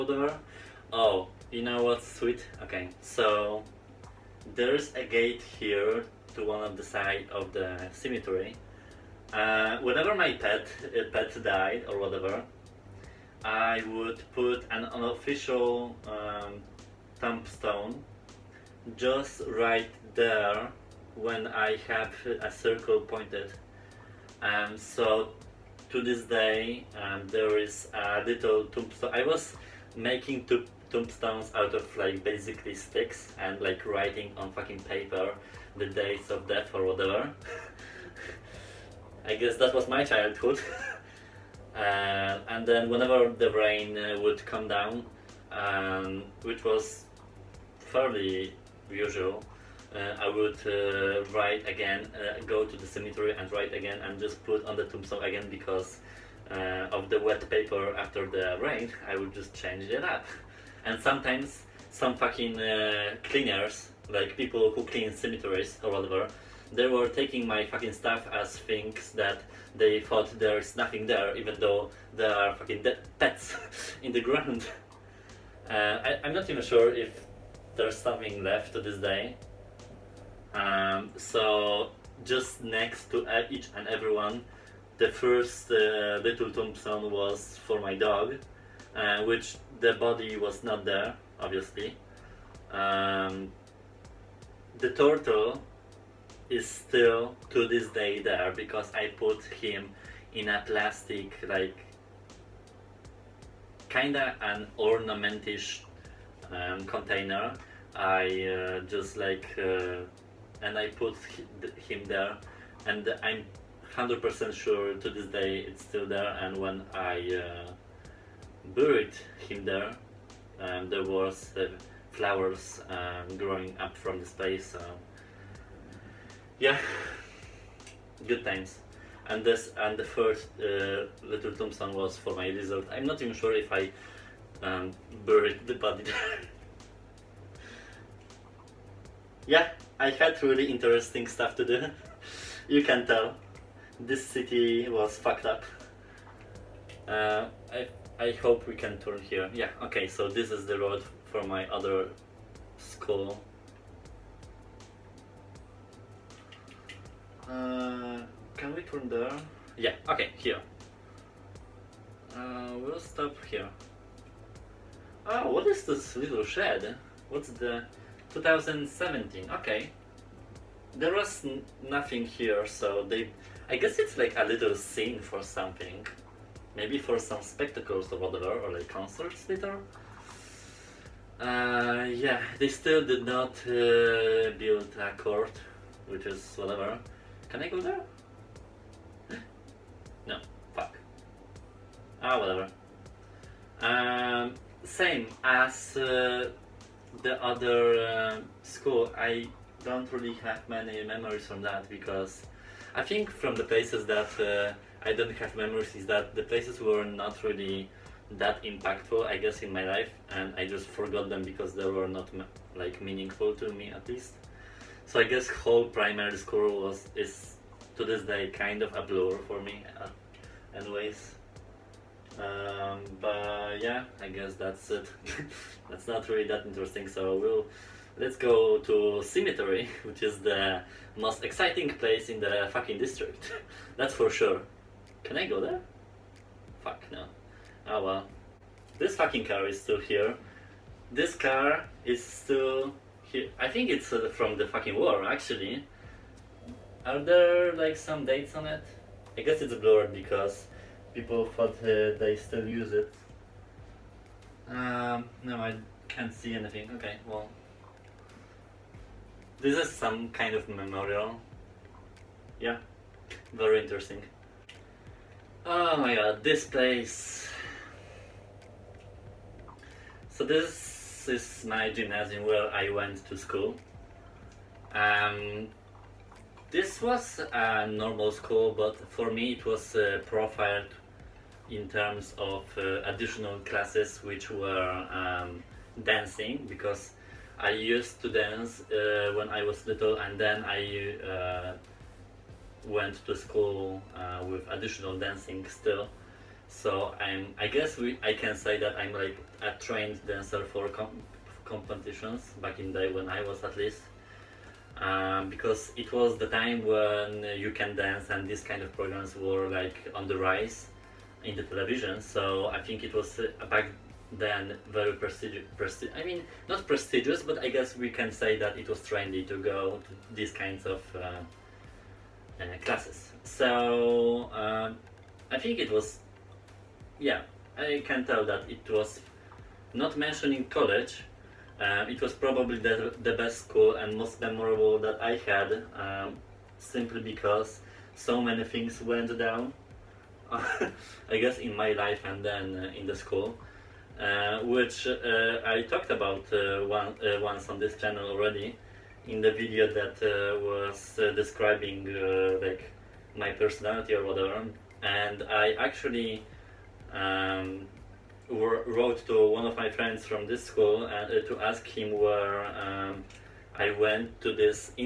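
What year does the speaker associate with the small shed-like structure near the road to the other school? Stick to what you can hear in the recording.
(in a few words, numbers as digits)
2017.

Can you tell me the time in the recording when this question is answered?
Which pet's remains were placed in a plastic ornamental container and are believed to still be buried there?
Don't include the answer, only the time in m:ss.
1:34.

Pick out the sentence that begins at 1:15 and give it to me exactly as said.
Uh, I, am not even sure if there's something left to this day.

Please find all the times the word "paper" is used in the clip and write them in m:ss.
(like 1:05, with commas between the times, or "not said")
0:34, 0:57.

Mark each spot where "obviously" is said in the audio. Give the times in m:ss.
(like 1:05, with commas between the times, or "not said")
1:31.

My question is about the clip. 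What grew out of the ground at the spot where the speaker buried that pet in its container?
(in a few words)
flowers.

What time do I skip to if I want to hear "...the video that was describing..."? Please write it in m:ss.
5:49.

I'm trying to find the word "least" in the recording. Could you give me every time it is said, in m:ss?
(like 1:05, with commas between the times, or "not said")
3:34, 5:03.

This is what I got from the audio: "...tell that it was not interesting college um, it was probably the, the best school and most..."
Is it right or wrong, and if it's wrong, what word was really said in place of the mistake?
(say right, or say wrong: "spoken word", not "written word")
wrong: "mentioning", not "interesting".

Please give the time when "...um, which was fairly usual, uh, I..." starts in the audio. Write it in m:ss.
0:45.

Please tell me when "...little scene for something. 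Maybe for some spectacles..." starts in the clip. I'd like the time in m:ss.
2:54.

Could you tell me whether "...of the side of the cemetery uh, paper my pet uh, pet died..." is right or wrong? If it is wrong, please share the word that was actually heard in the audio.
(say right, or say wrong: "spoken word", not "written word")
wrong: "whenever", not "paper".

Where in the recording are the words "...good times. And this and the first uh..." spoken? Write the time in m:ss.
2:08.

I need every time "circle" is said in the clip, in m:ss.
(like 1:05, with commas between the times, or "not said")
0:22.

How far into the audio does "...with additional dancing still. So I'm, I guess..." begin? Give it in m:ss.
4:54.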